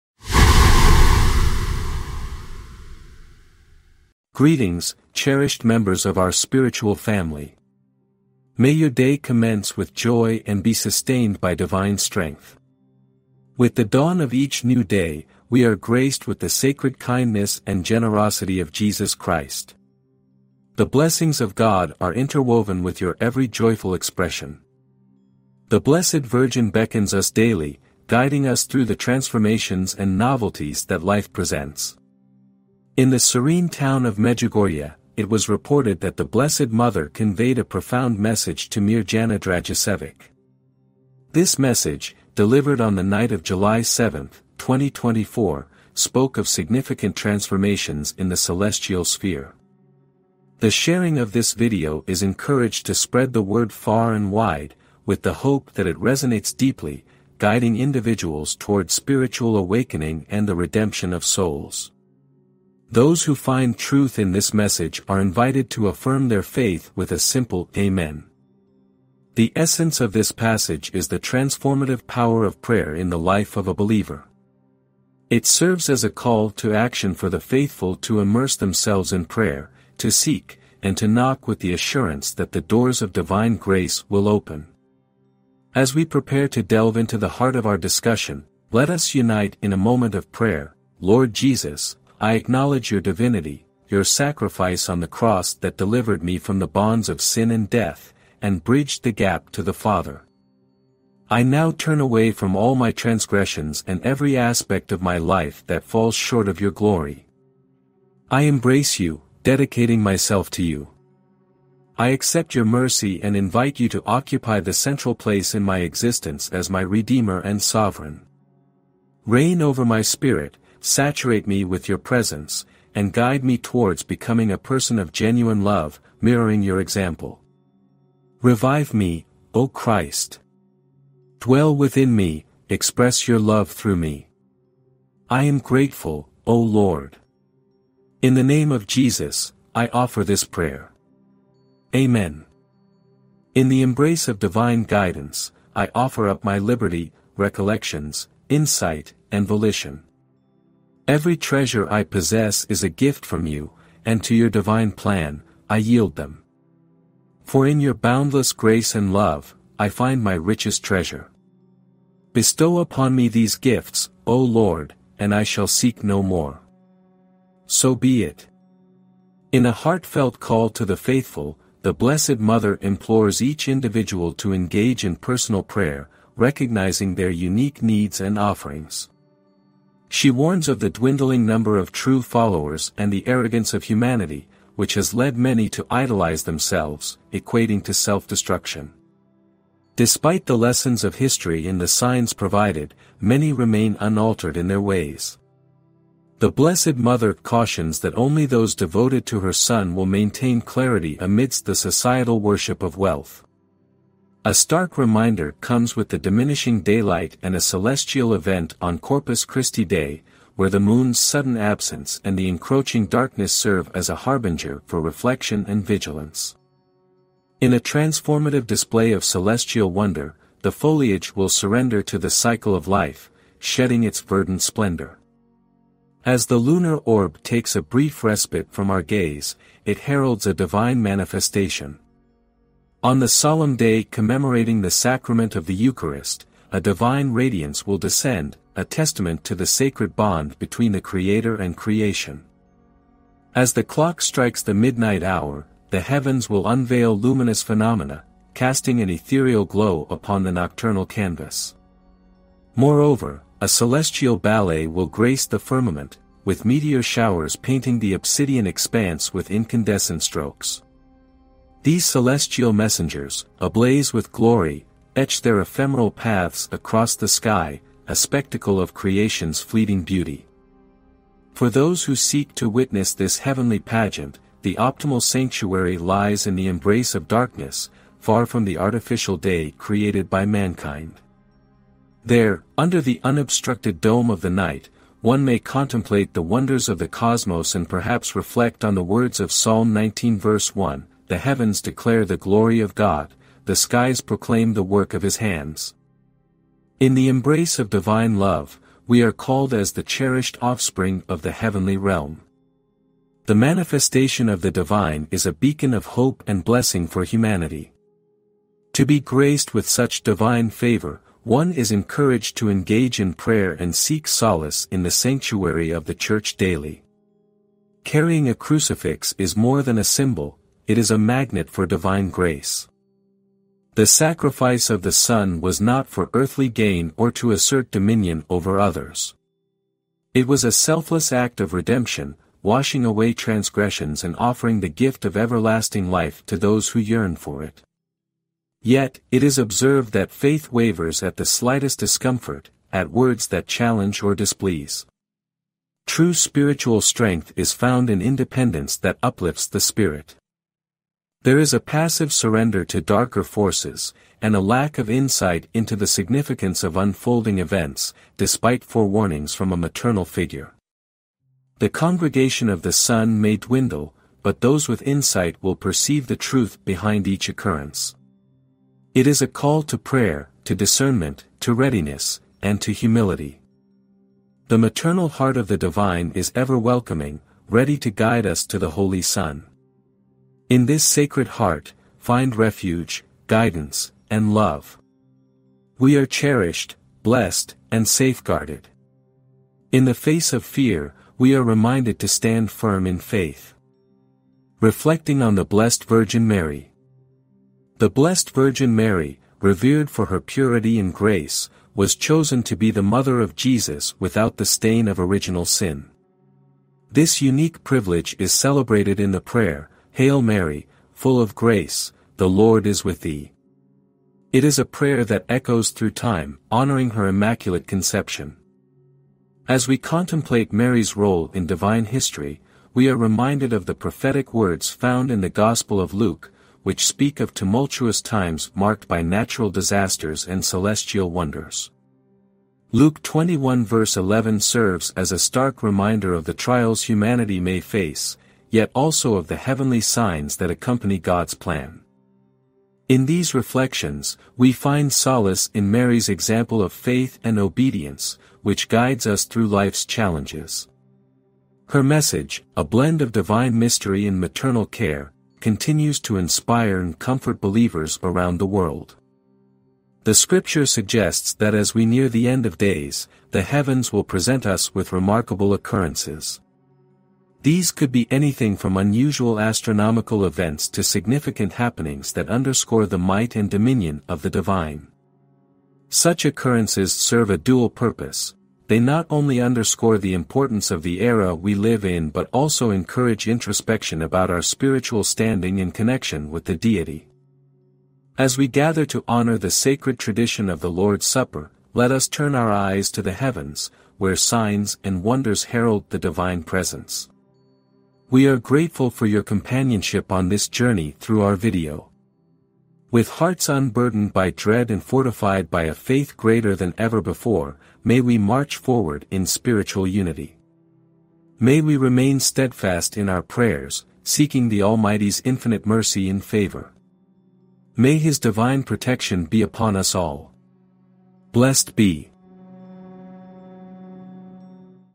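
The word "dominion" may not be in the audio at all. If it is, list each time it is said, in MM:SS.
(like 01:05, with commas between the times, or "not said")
05:27, 07:53.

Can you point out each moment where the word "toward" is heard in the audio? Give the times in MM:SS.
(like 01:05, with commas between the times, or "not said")
00:58, 02:03.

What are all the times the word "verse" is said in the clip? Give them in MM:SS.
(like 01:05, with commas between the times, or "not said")
04:50, 07:13.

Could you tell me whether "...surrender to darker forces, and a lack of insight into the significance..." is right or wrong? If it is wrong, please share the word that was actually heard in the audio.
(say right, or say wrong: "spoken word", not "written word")
right.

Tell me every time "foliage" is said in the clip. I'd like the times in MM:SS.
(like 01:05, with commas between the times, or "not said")
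03:40.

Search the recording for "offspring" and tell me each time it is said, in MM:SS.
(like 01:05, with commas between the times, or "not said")
05:00.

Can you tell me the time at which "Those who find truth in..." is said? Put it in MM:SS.
01:02.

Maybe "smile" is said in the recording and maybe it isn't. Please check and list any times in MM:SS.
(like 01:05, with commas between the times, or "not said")
not said.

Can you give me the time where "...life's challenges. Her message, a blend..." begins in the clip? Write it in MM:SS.
07:29.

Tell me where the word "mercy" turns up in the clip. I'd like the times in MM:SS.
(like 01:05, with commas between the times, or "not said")
01:52, 08:35.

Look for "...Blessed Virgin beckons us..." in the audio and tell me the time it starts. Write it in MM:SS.
00:25.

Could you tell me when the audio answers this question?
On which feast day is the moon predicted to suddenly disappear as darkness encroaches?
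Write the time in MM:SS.
03:28.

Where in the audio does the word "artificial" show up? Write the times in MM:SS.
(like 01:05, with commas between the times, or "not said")
04:38.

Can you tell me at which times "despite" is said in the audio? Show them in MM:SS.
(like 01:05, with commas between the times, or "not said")
03:09, 05:58.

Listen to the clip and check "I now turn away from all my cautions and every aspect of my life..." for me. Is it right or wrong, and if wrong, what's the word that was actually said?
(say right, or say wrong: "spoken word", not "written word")
wrong: "transgressions", not "cautions".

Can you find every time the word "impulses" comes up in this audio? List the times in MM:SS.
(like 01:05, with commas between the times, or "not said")
not said.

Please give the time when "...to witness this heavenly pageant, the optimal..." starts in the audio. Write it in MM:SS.
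04:32.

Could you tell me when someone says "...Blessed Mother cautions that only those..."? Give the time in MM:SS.
03:16.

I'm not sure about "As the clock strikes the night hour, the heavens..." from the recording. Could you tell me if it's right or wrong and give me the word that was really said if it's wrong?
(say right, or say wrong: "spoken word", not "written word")
wrong: "midnight", not "night".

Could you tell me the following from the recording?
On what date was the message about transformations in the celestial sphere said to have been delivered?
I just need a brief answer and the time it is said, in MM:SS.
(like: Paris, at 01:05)
July 7, 2024, at 00:43.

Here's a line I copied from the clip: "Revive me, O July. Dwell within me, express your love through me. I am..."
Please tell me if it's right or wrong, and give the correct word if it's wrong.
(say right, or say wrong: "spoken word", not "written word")
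wrong: "Christ", not "July".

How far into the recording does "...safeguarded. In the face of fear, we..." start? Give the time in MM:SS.
06:28.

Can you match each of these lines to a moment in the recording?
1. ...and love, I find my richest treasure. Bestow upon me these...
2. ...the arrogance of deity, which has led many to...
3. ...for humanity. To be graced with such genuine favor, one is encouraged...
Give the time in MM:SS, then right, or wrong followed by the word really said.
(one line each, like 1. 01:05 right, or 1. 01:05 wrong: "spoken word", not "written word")
1. 02:38 right
2. 03:03 wrong: "humanity", not "deity"
3. 05:07 wrong: "divine", not "genuine".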